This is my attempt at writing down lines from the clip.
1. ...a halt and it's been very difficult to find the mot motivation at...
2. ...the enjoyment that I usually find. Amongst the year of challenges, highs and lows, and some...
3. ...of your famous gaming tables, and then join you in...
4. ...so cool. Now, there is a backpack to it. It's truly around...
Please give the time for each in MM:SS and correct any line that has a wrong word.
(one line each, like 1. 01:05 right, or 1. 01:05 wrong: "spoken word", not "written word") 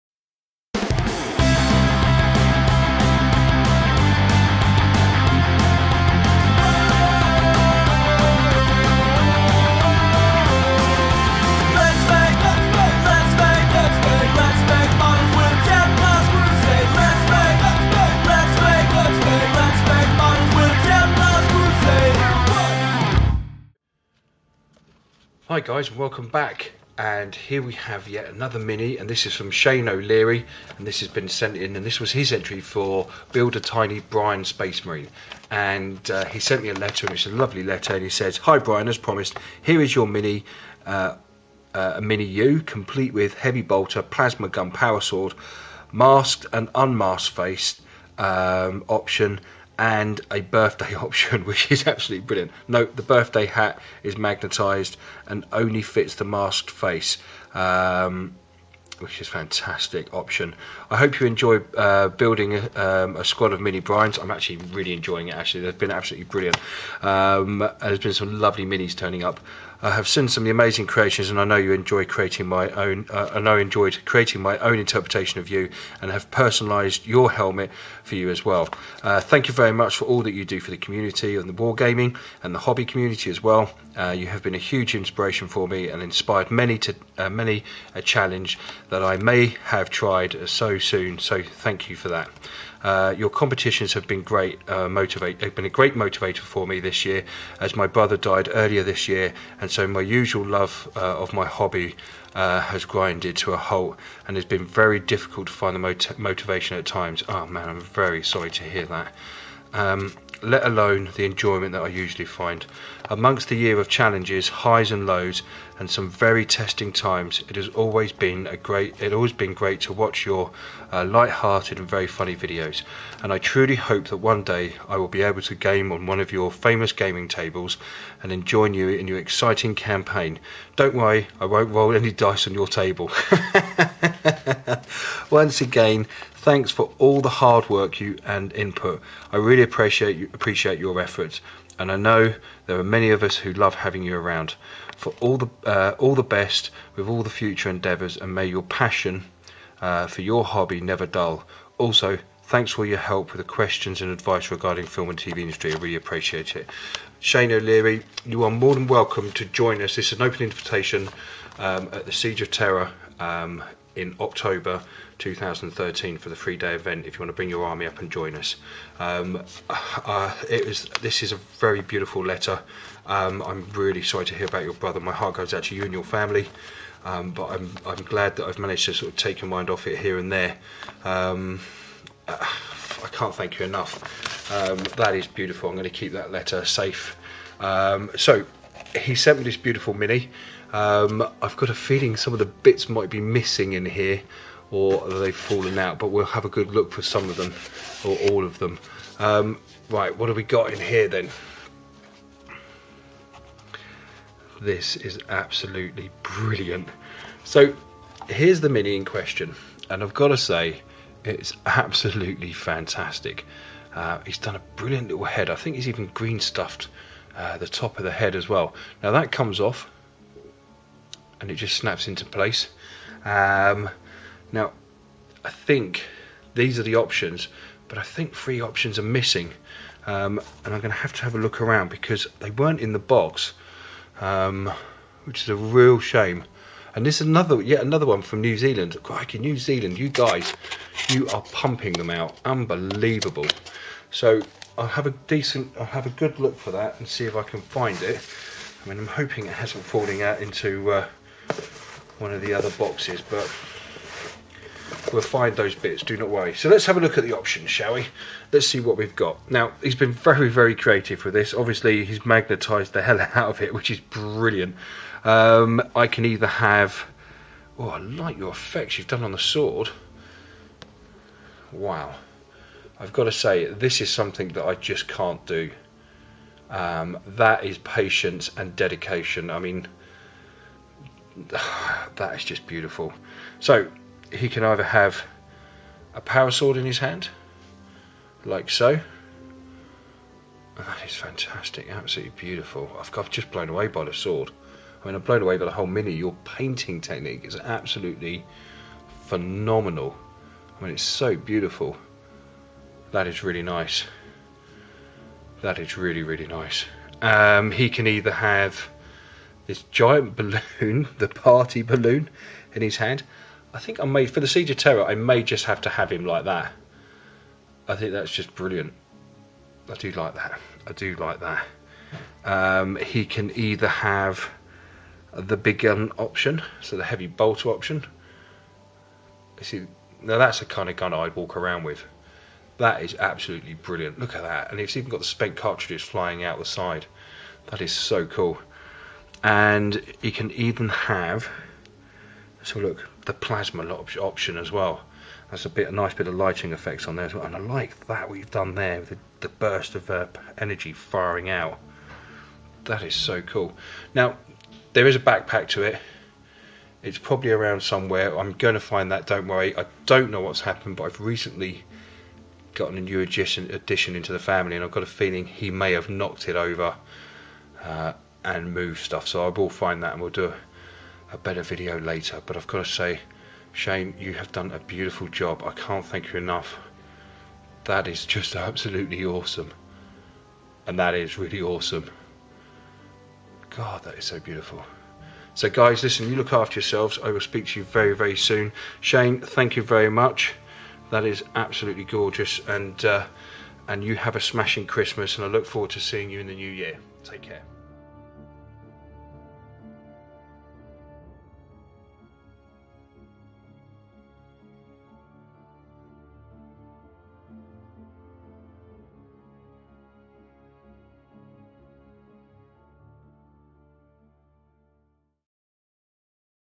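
1. 01:43 right
2. 01:51 right
3. 02:06 right
4. 05:53 wrong: "probably", not "truly".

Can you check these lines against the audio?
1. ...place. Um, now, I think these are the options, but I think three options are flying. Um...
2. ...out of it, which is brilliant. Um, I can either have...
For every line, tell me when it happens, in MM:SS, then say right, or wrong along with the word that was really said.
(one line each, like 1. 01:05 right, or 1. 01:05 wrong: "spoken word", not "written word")
1. 03:42 wrong: "missing", not "flying"
2. 04:23 right.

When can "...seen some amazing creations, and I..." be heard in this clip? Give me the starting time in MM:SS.
01:10.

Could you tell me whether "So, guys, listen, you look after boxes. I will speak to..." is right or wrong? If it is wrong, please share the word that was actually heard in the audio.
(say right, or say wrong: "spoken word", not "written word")
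wrong: "yourselves", not "boxes".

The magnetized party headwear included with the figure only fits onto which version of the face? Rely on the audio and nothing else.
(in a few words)
The masked face.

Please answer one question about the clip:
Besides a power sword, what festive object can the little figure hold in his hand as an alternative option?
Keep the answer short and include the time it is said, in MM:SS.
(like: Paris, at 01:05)
Party balloon, at 05:11.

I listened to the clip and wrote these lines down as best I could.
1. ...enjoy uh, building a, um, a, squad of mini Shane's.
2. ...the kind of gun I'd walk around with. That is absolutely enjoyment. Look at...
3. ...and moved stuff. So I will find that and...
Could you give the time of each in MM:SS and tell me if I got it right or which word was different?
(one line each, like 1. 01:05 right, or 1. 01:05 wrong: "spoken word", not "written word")
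1. 01:01 wrong: "Brian", not "Shane"
2. 05:30 wrong: "brilliant", not "enjoyment"
3. 06:08 right.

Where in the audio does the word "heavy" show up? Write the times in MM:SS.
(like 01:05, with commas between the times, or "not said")
00:43, 05:27.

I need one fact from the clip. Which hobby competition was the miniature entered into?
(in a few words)
Build a Tiny Brian Space Marine.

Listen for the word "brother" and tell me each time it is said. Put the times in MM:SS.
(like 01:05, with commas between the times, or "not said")
01:37, 02:54.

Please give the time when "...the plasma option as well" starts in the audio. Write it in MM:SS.
05:43.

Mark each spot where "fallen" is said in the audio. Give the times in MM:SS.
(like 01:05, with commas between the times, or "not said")
03:15, 04:09.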